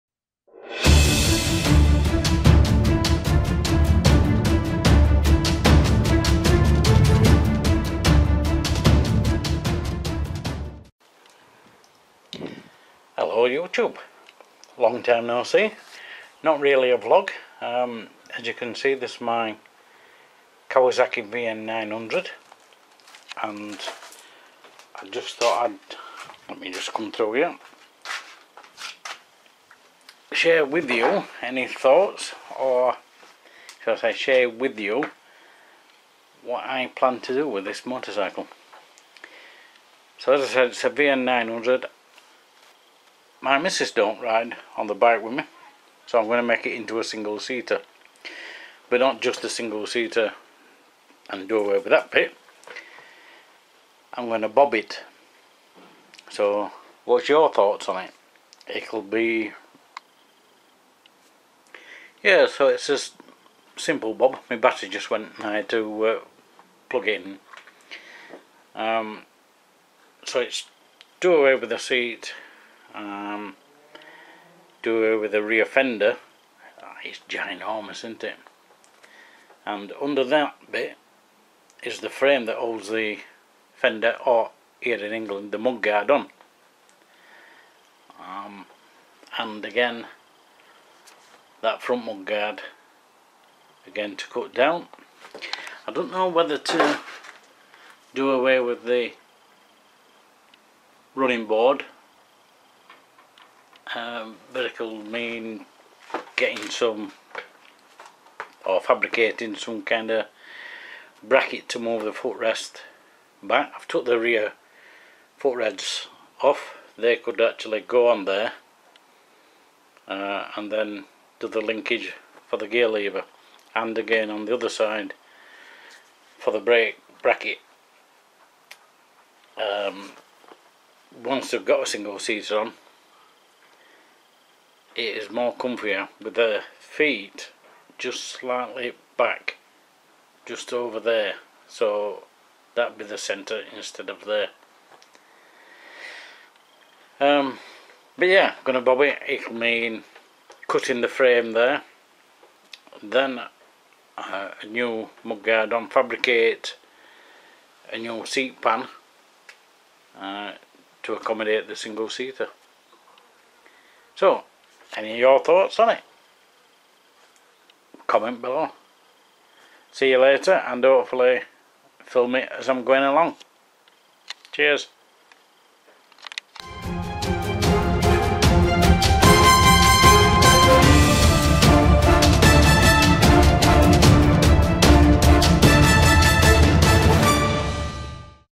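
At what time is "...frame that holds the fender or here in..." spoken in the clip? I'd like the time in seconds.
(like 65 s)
82 s.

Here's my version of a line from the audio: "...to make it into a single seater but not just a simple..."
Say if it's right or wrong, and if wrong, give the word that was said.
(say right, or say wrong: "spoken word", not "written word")
wrong: "single", not "simple".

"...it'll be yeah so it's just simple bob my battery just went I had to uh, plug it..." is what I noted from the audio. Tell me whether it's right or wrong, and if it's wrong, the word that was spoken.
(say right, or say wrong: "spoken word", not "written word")
right.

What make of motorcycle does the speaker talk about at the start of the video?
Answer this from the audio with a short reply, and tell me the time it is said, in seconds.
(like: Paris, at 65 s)
Kawasaki, at 20 s.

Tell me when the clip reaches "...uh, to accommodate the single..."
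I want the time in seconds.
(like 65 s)
160 s.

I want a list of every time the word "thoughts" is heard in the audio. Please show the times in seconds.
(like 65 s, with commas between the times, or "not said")
25 s, 31 s, 57 s, 165 s.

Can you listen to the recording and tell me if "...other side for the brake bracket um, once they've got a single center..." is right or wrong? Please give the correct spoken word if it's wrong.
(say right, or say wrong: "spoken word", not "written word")
wrong: "seater", not "center".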